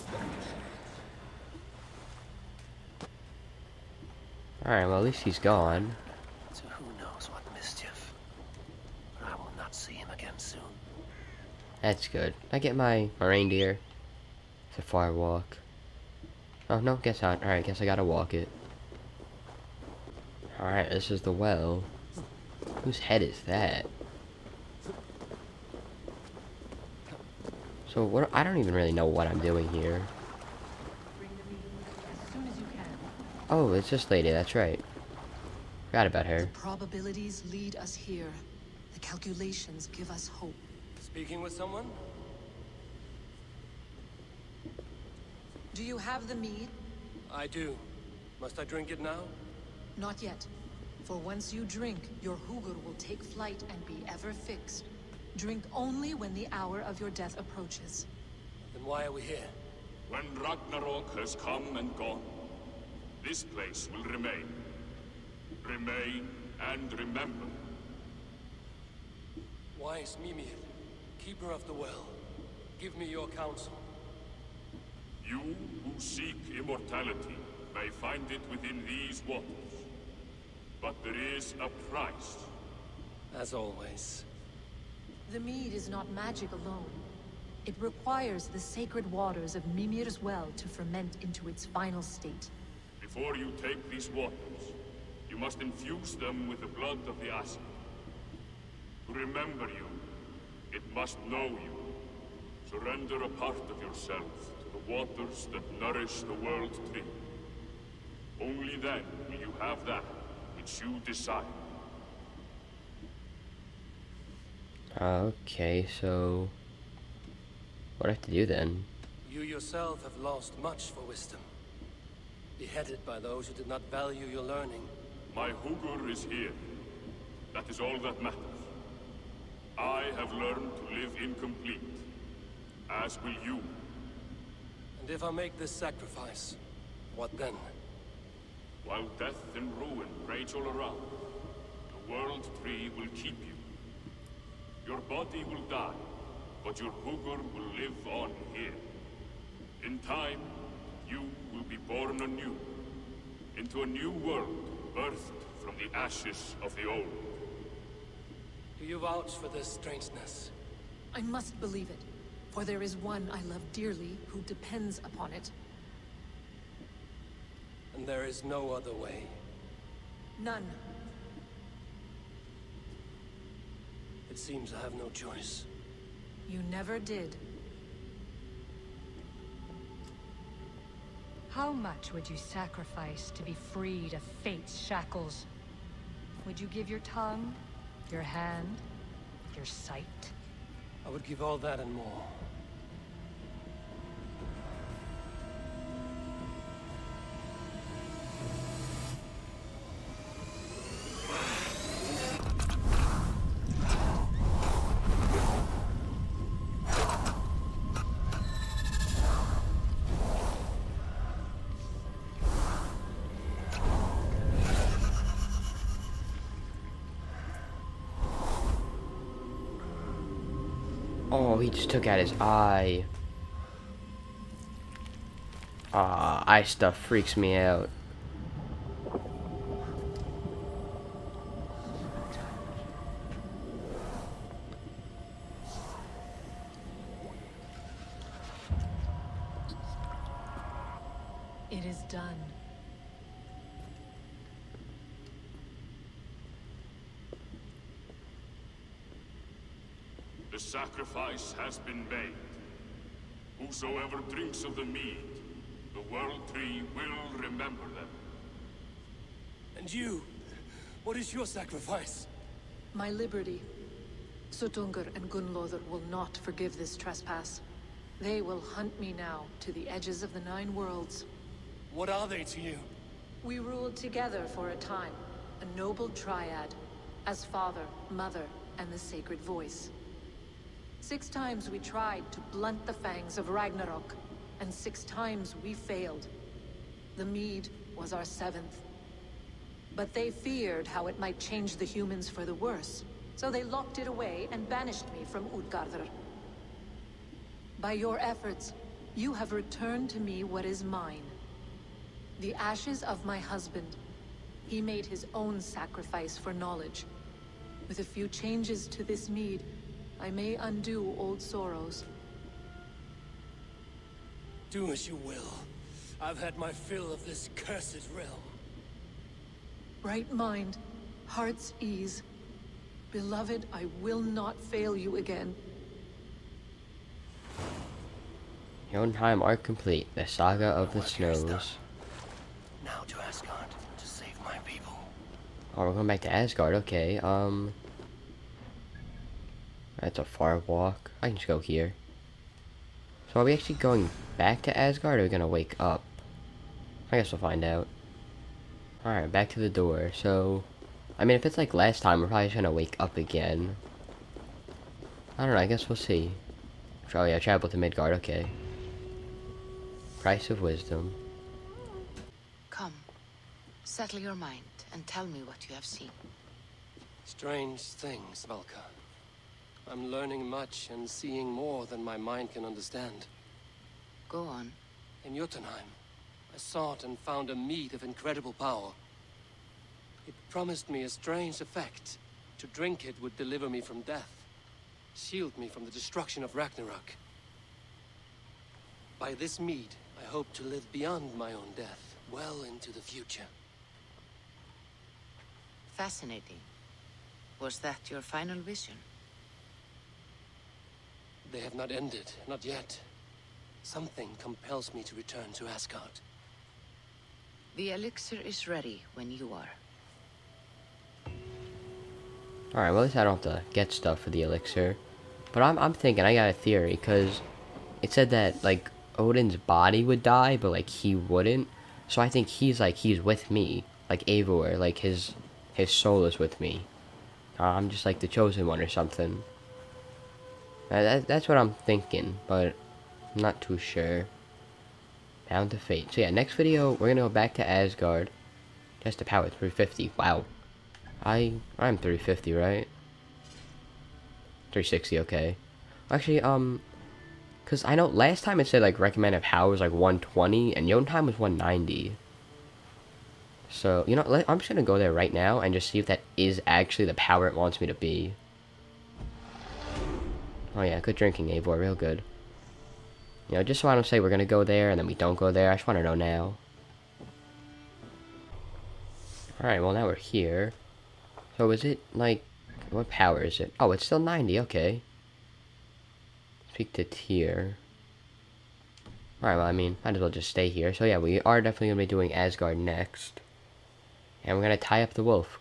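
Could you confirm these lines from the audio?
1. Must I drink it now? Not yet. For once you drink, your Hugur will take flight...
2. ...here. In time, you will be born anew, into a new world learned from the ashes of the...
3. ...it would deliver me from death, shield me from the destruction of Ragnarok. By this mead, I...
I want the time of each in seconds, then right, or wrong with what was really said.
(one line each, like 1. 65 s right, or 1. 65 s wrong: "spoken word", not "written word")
1. 48 s right
2. 148 s wrong: "birthed", not "learned"
3. 383 s right.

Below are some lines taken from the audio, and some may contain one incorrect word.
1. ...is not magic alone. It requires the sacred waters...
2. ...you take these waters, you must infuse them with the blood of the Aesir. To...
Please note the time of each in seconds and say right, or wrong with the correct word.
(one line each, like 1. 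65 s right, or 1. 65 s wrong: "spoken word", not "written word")
1. 85 s right
2. 93 s right.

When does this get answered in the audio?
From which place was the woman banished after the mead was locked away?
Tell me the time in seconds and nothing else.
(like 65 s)
295 s.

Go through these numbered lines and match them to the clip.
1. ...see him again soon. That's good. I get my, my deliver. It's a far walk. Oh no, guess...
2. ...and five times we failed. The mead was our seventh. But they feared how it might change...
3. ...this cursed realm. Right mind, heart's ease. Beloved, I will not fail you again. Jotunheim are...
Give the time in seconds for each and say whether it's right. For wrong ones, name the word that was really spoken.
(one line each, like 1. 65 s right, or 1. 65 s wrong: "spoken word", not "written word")
1. 9 s wrong: "reindeer", not "deliver"
2. 284 s wrong: "six", not "five"
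3. 317 s right.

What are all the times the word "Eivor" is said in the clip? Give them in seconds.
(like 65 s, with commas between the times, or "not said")
424 s, 461 s.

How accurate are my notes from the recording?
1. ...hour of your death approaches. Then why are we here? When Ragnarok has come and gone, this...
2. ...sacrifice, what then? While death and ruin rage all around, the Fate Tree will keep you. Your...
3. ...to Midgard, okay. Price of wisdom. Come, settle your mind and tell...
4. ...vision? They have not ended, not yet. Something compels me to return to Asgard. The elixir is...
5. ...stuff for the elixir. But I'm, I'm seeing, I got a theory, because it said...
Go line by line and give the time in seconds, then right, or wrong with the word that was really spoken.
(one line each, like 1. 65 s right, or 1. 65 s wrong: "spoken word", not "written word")
1. 56 s right
2. 135 s wrong: "World", not "Fate"
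3. 357 s right
4. 398 s right
5. 413 s wrong: "thinking", not "seeing".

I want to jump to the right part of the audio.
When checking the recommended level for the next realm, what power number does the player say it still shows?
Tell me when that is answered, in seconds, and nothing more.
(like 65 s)
474 s.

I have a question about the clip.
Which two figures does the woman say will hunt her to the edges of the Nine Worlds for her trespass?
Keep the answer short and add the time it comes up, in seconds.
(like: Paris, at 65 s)
Suttungr and Gunlother, at 264 s.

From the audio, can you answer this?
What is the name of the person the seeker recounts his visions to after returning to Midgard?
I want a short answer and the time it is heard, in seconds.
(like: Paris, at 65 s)
Valka, at 368 s.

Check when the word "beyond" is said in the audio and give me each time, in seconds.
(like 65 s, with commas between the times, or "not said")
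390 s.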